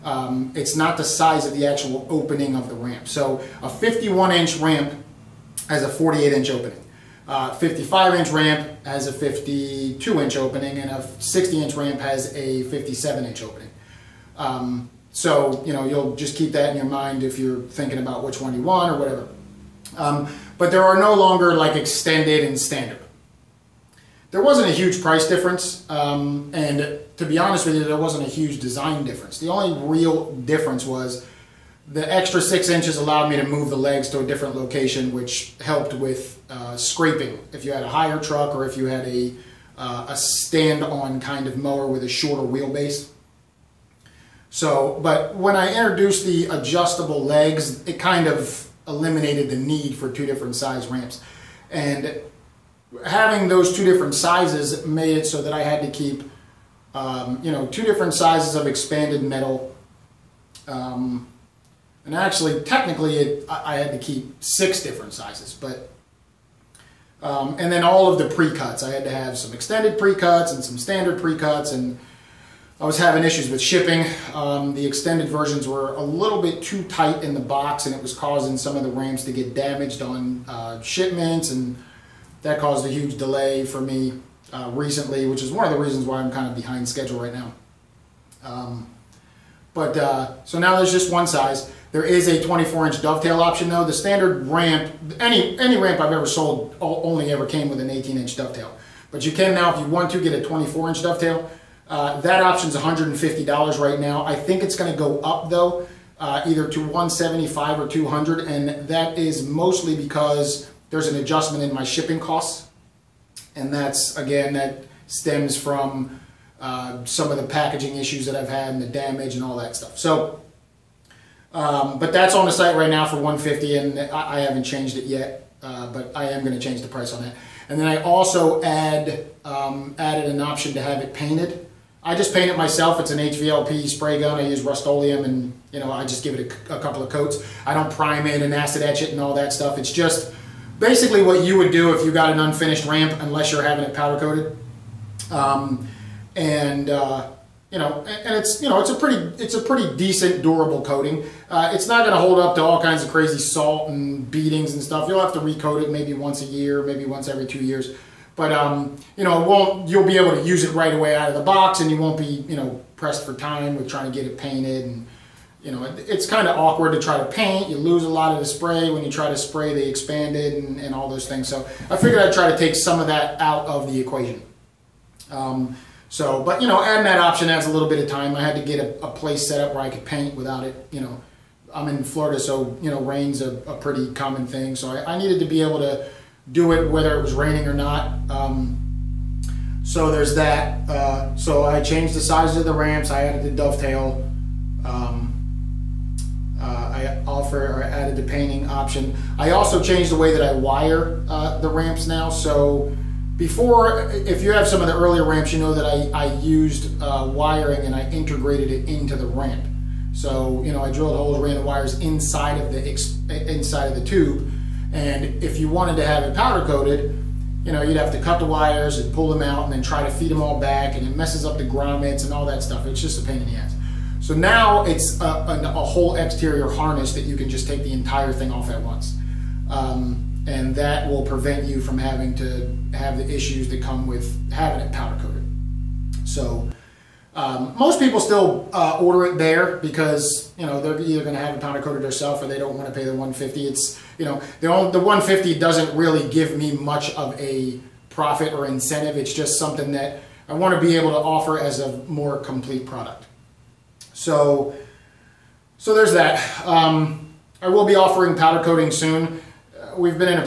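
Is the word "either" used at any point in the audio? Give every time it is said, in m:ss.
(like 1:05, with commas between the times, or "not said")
1:46, 4:00.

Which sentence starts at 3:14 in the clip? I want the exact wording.
Um, uh, I offer or added the painting option.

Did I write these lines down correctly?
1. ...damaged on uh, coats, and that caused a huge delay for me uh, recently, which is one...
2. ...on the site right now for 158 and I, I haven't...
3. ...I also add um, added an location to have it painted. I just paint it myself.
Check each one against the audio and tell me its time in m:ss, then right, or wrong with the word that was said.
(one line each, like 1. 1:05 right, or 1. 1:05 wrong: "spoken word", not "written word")
1. 1:19 wrong: "shipments", not "coats"
2. 2:02 wrong: "150", not "158"
3. 2:07 wrong: "option", not "location".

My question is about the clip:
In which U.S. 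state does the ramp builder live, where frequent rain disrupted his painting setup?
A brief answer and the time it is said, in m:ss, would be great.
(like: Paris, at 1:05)
Florida, at 3:02.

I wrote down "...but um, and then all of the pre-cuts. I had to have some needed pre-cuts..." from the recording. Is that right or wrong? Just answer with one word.
wrong.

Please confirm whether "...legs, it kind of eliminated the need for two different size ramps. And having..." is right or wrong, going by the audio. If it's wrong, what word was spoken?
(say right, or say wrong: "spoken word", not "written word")
right.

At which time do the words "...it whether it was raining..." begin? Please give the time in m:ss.
3:06.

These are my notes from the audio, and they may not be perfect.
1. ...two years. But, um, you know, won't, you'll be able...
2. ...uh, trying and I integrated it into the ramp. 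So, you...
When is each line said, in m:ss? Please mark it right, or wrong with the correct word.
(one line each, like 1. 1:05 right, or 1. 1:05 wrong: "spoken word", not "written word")
1. 2:37 right
2. 3:27 wrong: "wiring", not "trying".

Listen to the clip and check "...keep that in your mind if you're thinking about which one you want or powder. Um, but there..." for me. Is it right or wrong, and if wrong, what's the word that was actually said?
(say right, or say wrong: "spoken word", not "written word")
wrong: "whatever", not "powder".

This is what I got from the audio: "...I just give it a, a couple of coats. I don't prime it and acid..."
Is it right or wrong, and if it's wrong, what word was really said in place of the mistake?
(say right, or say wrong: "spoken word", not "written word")
right.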